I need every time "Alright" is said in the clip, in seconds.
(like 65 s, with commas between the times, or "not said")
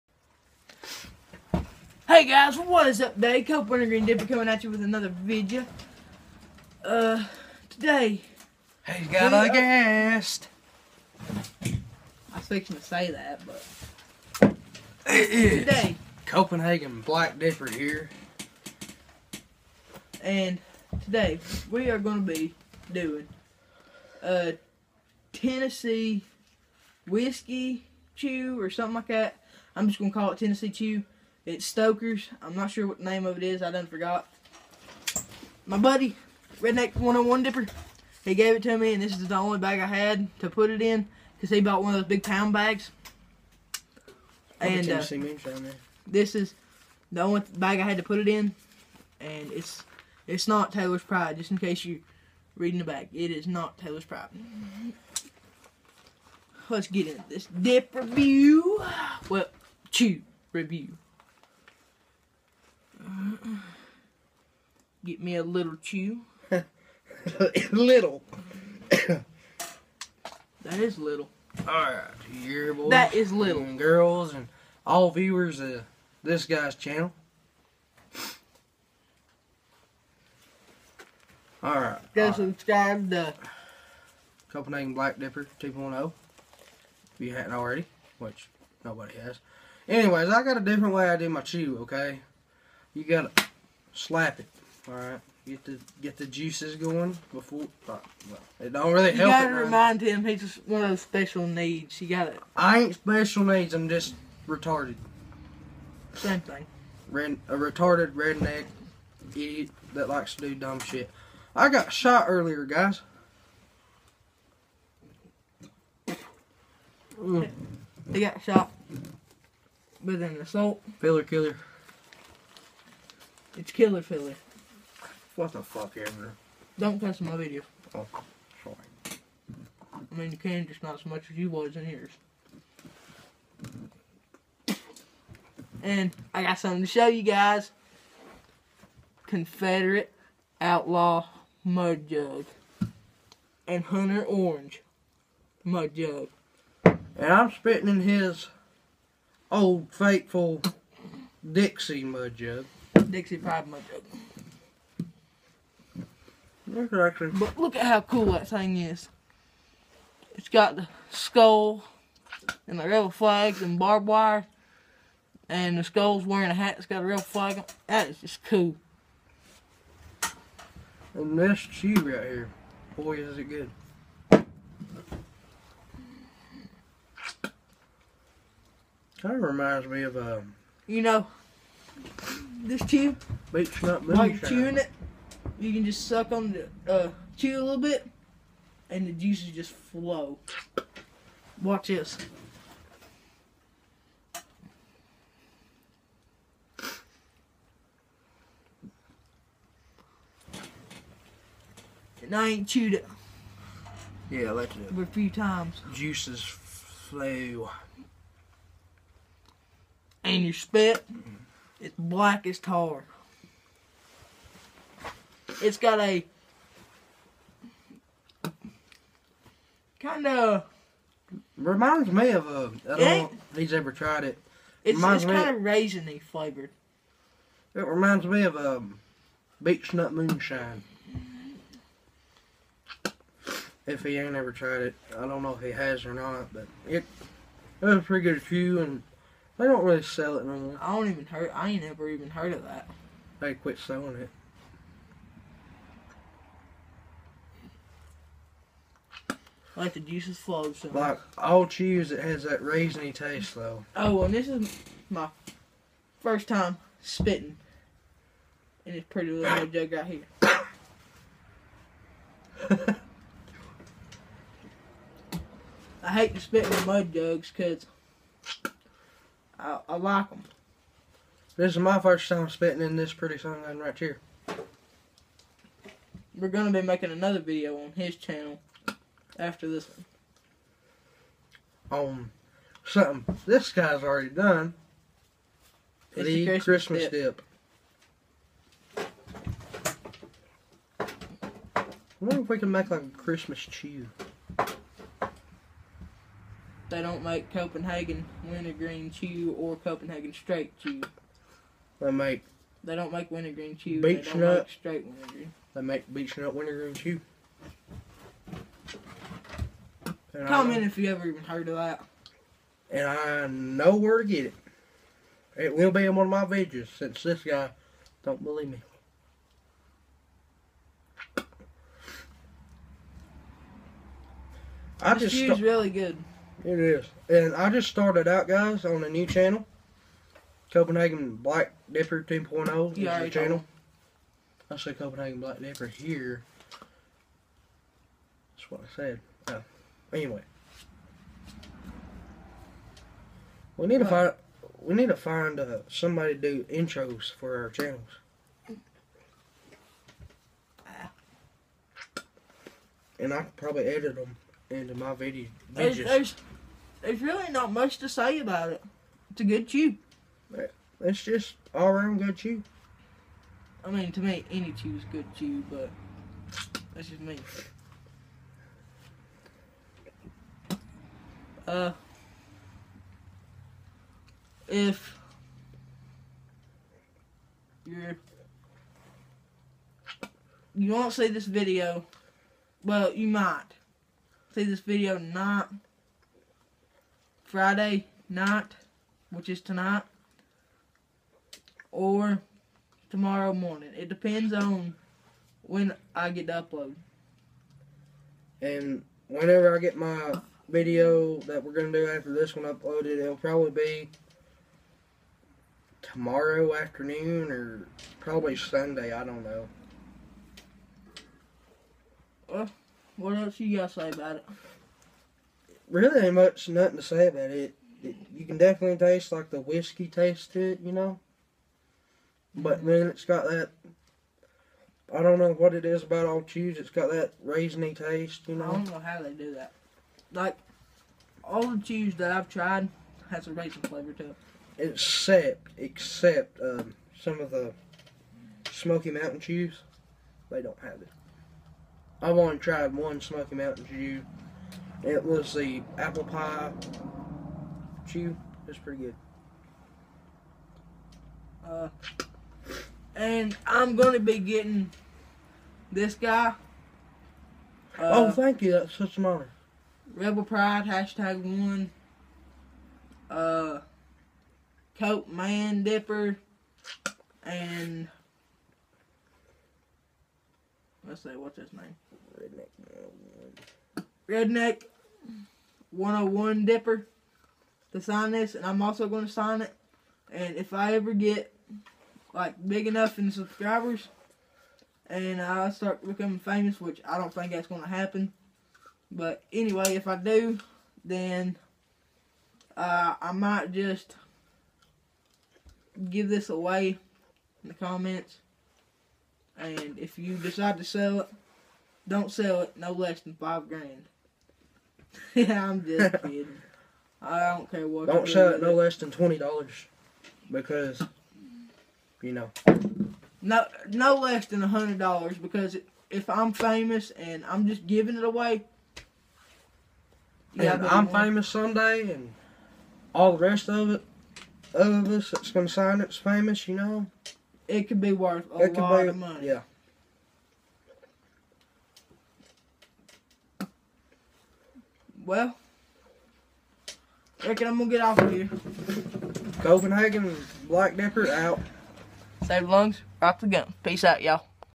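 71 s, 81 s.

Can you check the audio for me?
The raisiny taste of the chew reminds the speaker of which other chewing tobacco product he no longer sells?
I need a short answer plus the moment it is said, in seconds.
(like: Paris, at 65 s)
Beech Nut Moonshine, at 229 s.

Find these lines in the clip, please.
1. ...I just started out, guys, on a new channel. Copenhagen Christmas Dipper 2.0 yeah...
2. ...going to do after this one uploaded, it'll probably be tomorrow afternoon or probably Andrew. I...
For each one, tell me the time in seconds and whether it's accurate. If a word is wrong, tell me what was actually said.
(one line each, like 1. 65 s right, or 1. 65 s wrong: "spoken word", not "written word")
1. 327 s wrong: "Black", not "Christmas"
2. 401 s wrong: "Sunday", not "Andrew".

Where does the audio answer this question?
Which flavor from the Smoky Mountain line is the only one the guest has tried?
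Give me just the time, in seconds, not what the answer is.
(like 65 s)
445 s.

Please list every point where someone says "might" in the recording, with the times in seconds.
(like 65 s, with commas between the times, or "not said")
383 s, 493 s.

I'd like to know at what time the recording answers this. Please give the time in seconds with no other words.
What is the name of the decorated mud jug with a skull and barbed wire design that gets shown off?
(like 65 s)
139 s.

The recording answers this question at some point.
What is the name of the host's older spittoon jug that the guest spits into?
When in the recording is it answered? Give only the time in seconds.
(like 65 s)
151 s.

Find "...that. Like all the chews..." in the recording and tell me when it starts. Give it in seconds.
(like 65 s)
429 s.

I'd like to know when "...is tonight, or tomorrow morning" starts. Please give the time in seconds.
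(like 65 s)
389 s.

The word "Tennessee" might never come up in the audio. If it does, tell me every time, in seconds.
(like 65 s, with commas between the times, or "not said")
25 s, 30 s.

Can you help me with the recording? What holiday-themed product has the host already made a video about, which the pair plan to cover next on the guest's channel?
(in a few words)
Christmas dip.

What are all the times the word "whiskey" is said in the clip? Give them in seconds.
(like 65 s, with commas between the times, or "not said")
27 s, 419 s.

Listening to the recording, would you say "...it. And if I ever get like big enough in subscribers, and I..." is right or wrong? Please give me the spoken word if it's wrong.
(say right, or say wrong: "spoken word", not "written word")
right.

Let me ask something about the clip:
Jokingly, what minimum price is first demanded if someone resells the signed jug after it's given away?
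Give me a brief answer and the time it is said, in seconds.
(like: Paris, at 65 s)
five grand, at 503 s.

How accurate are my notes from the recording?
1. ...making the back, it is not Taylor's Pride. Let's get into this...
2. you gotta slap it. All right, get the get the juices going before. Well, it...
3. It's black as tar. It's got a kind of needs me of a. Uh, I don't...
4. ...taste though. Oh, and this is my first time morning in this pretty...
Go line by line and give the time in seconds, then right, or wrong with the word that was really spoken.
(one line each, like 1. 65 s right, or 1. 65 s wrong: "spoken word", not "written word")
1. 52 s wrong: "reading", not "making"
2. 92 s right
3. 211 s wrong: "reminds", not "needs"
4. 253 s wrong: "spitting", not "morning".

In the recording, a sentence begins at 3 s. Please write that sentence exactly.
Cope Winter Green Dipper coming at you with another video.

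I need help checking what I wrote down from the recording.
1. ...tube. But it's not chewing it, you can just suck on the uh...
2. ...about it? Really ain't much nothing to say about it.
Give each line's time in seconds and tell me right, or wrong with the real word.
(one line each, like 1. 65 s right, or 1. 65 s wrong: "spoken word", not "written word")
1. 182 s right
2. 414 s right.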